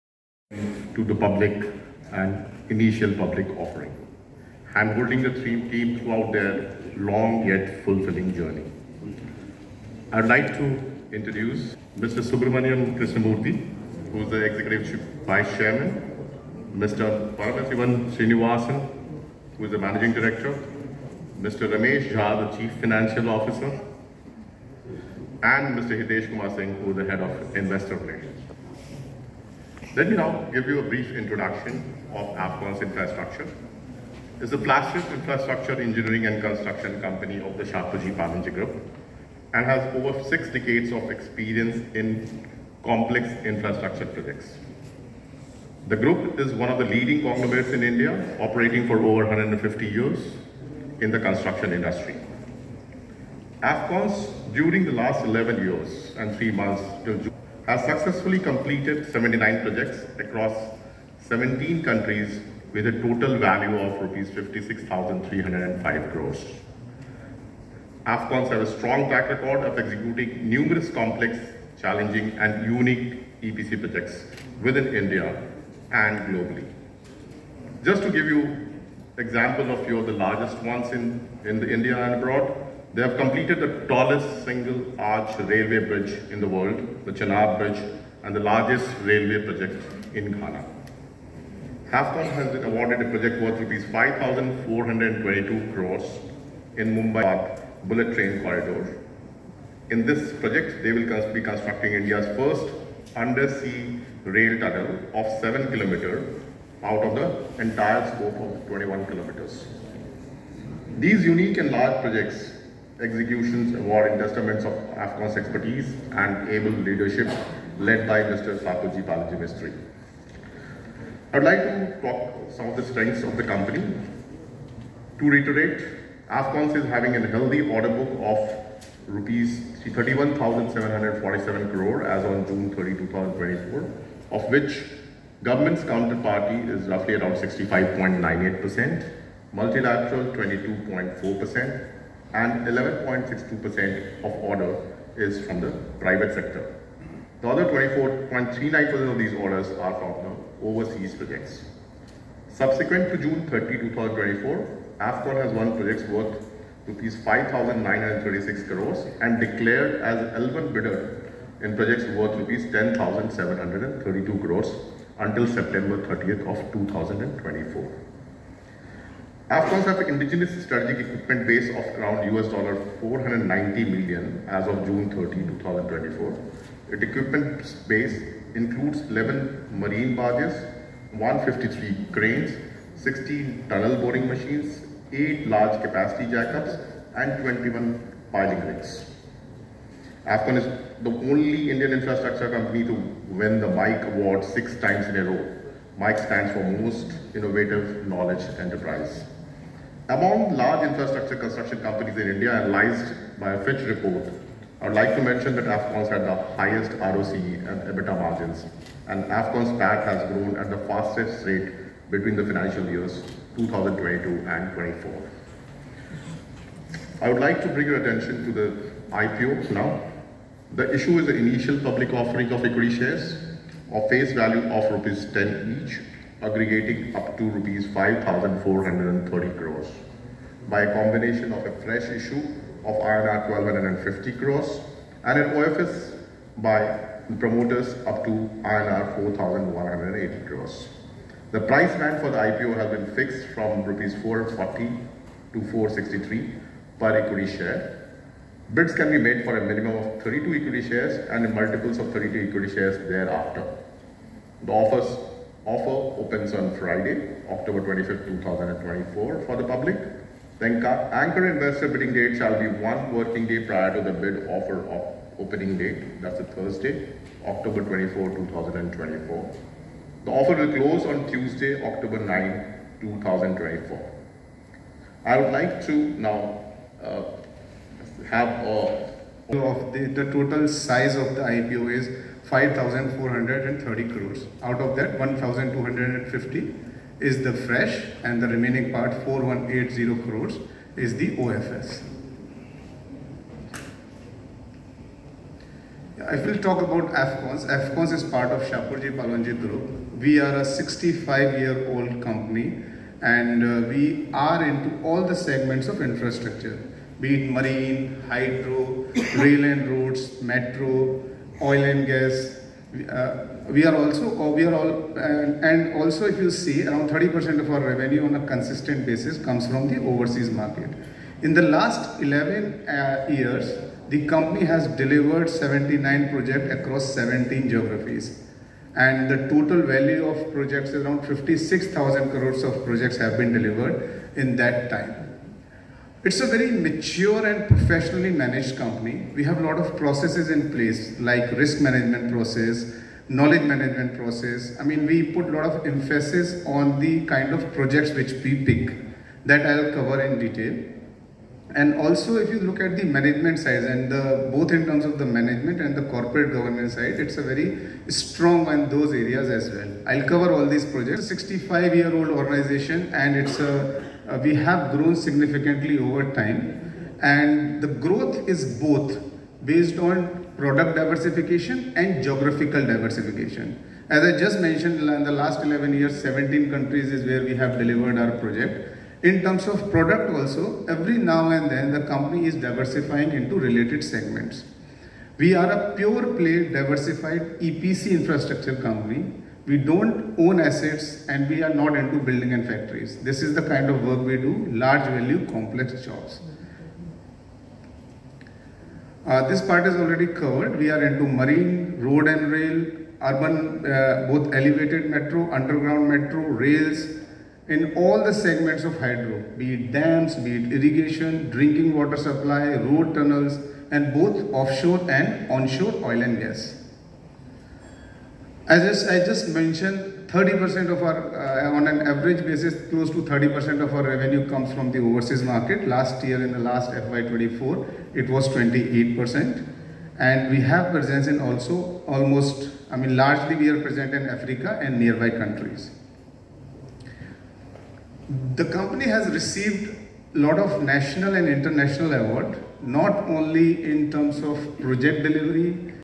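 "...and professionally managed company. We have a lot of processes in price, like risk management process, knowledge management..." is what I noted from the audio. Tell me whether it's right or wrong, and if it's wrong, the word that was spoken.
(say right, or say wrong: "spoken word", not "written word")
wrong: "place", not "price".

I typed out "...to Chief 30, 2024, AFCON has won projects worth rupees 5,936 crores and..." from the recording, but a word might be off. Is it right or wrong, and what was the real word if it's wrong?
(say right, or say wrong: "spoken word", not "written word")
wrong: "June", not "Chief".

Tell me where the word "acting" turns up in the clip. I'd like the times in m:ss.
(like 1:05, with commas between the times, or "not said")
not said.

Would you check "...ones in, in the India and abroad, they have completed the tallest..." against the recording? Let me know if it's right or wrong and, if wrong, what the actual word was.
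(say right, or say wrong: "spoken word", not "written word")
right.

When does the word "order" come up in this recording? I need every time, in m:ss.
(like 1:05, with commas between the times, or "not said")
2:07, 2:24, 2:29.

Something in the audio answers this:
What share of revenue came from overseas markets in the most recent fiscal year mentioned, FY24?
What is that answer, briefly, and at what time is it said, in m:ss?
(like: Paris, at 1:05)
28%, at 7:08.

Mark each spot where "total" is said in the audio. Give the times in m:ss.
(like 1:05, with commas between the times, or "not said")
1:02, 4:40, 5:29.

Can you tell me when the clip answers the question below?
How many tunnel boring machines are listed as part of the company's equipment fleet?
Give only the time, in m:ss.
3:02.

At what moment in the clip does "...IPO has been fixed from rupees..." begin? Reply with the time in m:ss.
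4:02.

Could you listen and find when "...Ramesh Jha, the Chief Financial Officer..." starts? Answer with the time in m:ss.
0:21.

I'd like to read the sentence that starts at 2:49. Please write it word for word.
Afcons have indigenous strategic equipment base of around US dollar 490 million as of June 30, 2024.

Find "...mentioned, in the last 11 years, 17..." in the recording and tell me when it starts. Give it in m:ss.
6:14.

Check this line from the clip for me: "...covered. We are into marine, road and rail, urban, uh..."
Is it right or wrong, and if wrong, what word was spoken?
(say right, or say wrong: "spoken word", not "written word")
right.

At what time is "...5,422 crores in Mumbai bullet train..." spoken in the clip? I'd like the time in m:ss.
1:33.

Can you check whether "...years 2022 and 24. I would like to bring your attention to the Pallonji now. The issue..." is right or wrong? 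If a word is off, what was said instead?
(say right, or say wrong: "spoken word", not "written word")
wrong: "IPO", not "Pallonji".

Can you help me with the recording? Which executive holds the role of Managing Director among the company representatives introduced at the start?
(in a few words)
Paramasivan Srinivasan.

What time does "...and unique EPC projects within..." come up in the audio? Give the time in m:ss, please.
1:12.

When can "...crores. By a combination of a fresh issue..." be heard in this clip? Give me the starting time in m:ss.
3:49.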